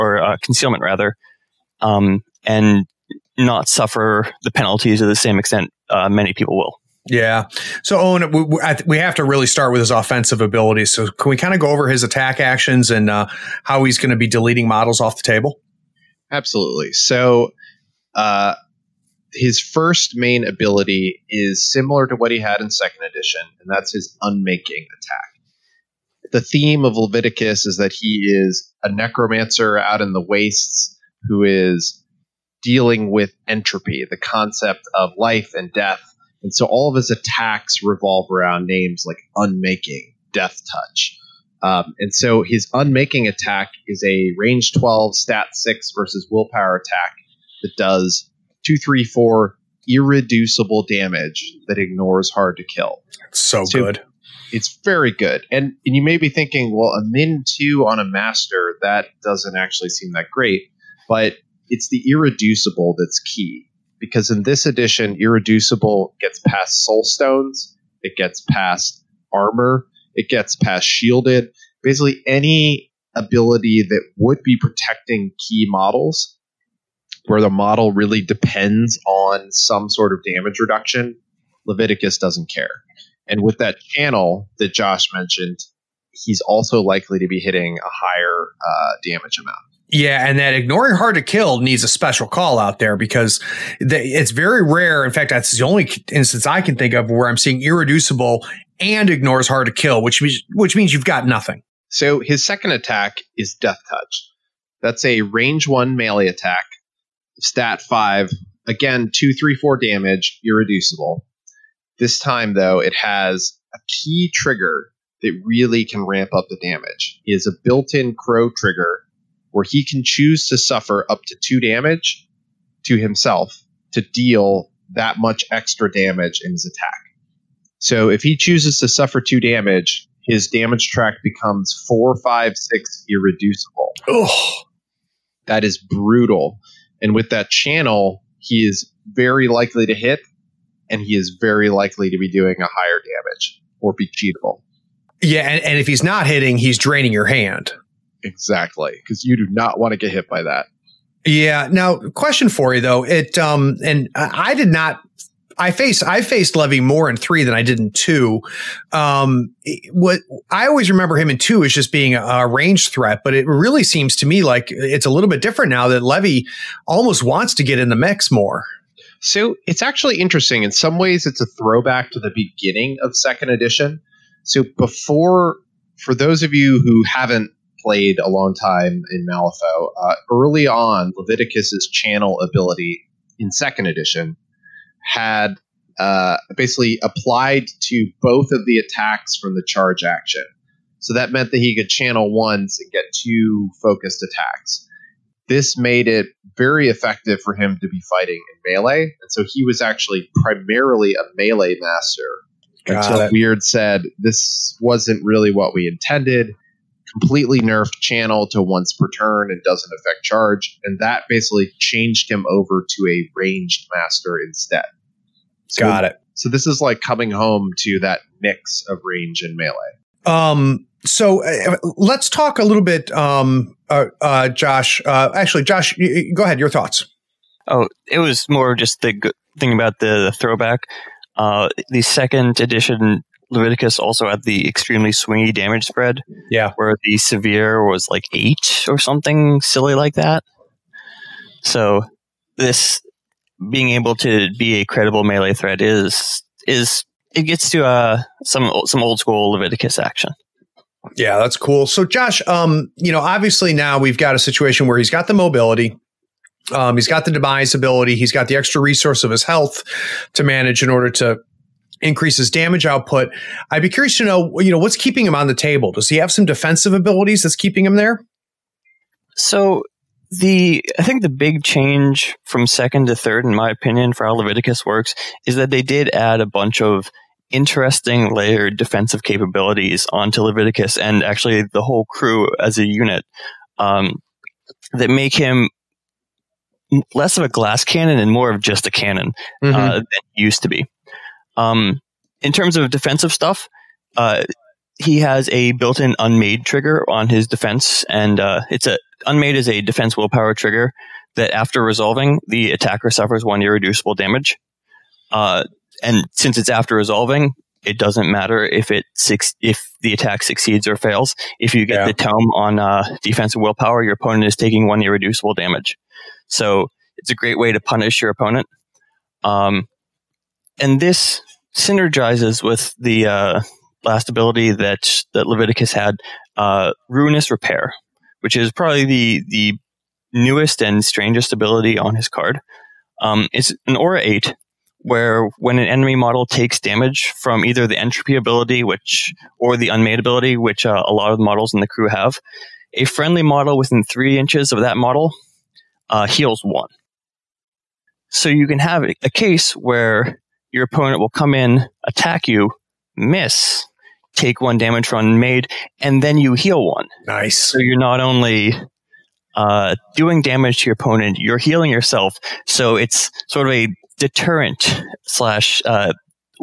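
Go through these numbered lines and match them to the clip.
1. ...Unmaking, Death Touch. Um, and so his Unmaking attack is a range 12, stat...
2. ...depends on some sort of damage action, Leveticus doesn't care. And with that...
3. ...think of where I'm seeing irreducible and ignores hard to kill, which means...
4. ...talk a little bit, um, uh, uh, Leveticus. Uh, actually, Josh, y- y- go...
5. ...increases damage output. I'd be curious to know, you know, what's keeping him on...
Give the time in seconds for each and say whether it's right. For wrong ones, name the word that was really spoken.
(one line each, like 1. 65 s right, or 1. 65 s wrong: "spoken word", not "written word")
1. 39 s right
2. 78 s wrong: "reduction", not "action"
3. 96 s right
4. 222 s wrong: "Josh", not "Leveticus"
5. 262 s right.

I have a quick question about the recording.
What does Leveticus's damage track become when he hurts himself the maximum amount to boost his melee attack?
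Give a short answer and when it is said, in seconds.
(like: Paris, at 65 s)
4, 5, 6, at 131 s.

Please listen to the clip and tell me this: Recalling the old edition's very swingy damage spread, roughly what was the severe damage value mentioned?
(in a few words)
8.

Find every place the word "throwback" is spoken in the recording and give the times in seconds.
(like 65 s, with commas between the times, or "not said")
171 s, 230 s.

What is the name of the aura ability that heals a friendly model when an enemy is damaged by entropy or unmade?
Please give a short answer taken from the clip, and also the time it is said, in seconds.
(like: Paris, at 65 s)
Ruinous Repair, at 327 s.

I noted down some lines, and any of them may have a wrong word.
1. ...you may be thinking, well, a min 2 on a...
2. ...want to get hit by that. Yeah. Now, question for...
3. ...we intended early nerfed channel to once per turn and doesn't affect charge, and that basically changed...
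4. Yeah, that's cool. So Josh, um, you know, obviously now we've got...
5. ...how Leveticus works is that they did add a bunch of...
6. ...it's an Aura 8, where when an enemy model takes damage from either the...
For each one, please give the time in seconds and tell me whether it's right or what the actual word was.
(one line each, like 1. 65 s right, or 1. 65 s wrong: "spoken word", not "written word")
1. 55 s right
2. 149 s right
3. 205 s wrong: "completely", not "early"
4. 251 s right
5. 274 s right
6. 333 s right.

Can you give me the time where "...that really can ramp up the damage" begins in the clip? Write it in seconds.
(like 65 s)
115 s.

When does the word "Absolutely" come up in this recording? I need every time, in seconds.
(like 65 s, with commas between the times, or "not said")
16 s.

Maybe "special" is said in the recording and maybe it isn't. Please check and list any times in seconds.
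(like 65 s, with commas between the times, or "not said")
91 s.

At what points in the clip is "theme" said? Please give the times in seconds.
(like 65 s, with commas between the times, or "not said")
26 s.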